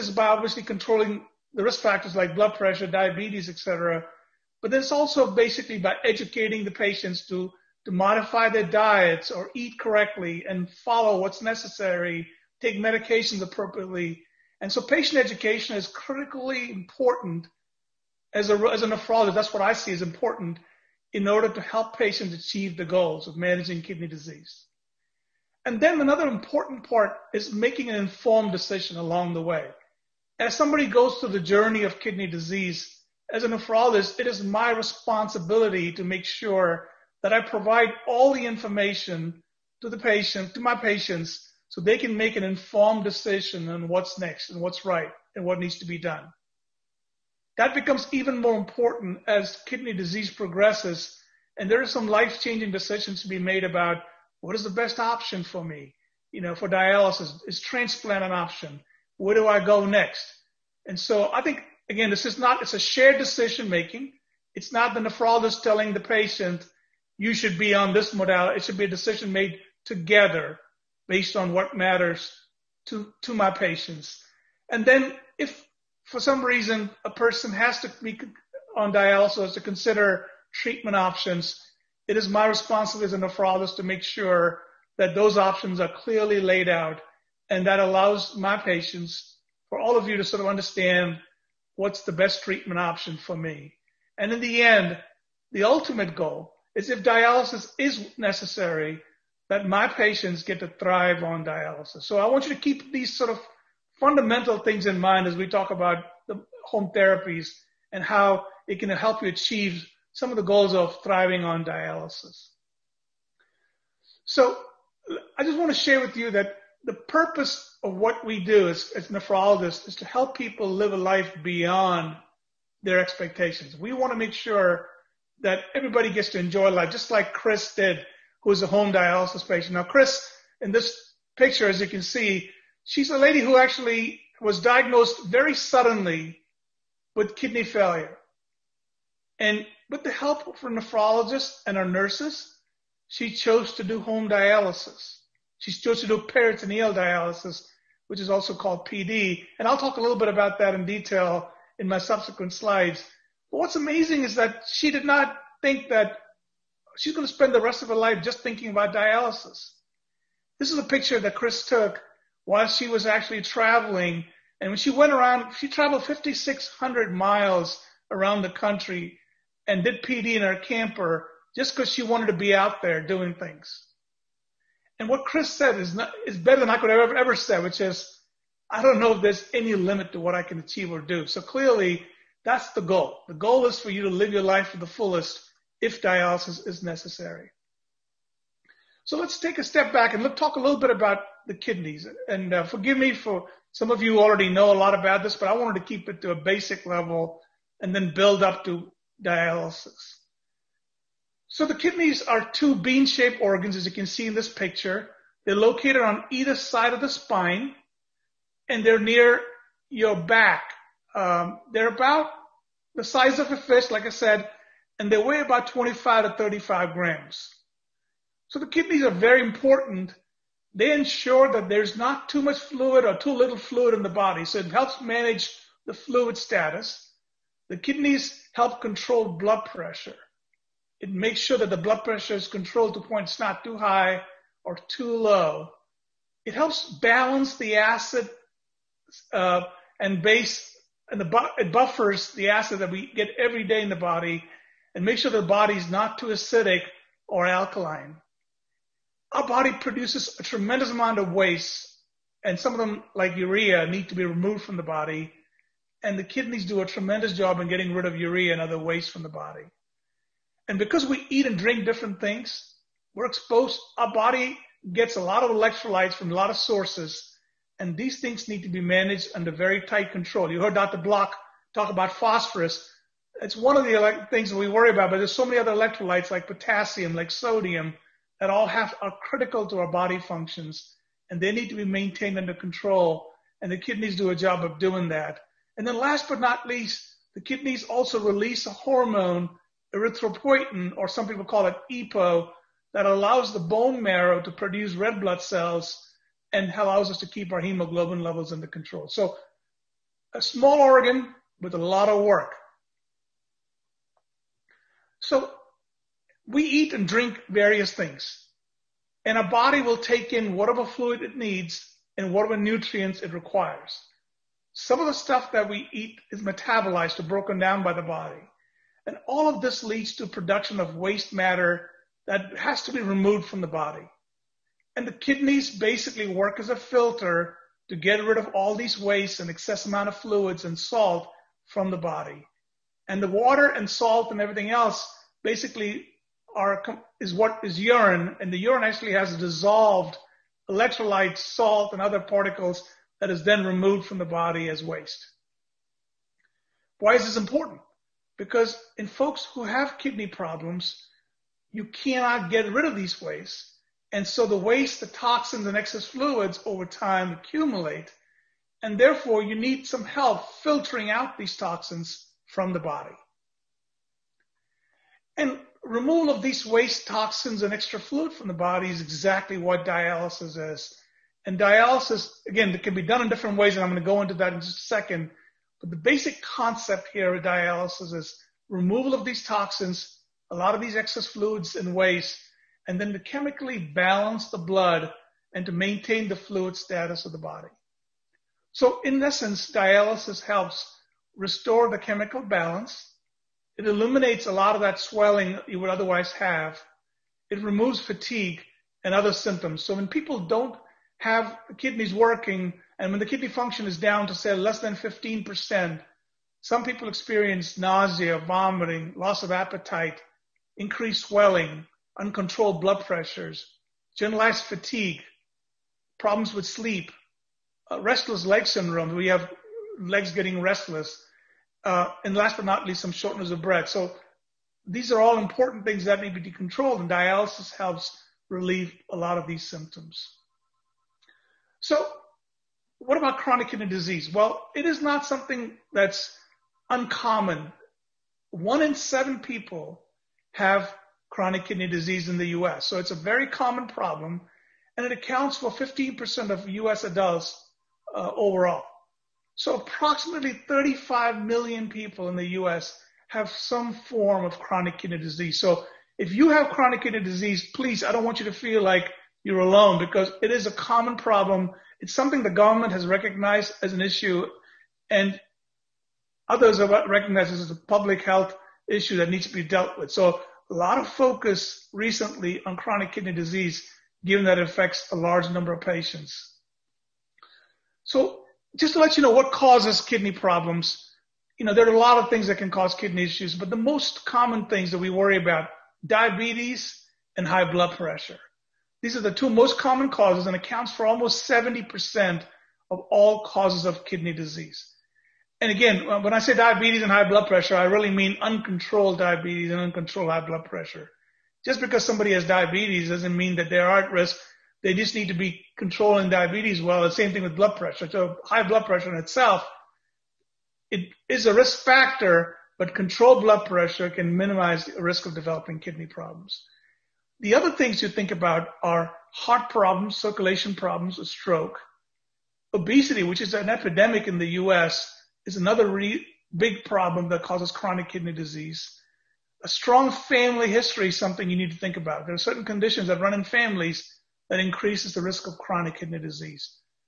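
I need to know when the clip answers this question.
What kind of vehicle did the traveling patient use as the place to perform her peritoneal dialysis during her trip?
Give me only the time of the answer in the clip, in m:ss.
2:50.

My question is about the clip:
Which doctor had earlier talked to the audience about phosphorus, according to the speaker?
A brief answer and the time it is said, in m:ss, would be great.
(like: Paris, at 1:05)
Dr. Block, at 4:30.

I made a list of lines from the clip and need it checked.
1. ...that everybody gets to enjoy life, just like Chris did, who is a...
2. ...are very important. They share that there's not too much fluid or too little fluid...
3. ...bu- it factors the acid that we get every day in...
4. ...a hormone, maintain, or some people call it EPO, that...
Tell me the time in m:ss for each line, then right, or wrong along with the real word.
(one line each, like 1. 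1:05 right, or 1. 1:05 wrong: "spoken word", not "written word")
1. 2:05 right
2. 3:39 wrong: "ensure", not "share"
3. 4:01 wrong: "buffers", not "factors"
4. 4:48 wrong: "erythropoietin", not "maintain".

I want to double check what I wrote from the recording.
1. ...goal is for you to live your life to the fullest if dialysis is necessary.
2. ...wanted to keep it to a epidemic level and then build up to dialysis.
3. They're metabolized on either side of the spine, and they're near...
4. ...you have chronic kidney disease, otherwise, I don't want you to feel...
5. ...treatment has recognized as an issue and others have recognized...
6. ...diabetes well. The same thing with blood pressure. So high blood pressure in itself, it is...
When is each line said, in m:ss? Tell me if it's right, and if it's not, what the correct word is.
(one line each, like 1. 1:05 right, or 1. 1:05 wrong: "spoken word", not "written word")
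1. 3:03 right
2. 3:15 wrong: "basic", not "epidemic"
3. 3:25 wrong: "located", not "metabolized"
4. 7:36 wrong: "please", not "otherwise"
5. 7:42 wrong: "government", not "treatment"
6. 8:26 right.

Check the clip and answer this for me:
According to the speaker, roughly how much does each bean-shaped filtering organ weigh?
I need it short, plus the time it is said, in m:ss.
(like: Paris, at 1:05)
25 to 35 grams, at 3:35.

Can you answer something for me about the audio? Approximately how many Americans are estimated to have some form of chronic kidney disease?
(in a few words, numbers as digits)
35 million.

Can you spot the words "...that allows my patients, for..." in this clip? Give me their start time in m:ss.
1:27.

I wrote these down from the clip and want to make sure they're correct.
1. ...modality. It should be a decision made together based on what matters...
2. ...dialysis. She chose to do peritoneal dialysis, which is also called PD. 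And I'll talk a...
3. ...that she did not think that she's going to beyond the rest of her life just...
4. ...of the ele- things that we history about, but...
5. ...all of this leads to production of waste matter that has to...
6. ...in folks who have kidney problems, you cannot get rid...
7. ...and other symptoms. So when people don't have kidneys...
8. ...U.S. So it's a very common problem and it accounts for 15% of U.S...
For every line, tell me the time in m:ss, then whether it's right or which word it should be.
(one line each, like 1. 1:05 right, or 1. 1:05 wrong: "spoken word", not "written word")
1. 1:08 right
2. 2:24 right
3. 2:34 wrong: "spend", not "beyond"
4. 4:33 wrong: "worry", not "history"
5. 5:19 right
6. 5:48 right
7. 6:39 right
8. 7:22 right.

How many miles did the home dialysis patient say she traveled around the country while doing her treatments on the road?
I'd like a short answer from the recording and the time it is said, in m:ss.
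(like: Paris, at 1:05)
5,600 miles, at 2:46.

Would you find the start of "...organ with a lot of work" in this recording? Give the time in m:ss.
5:00.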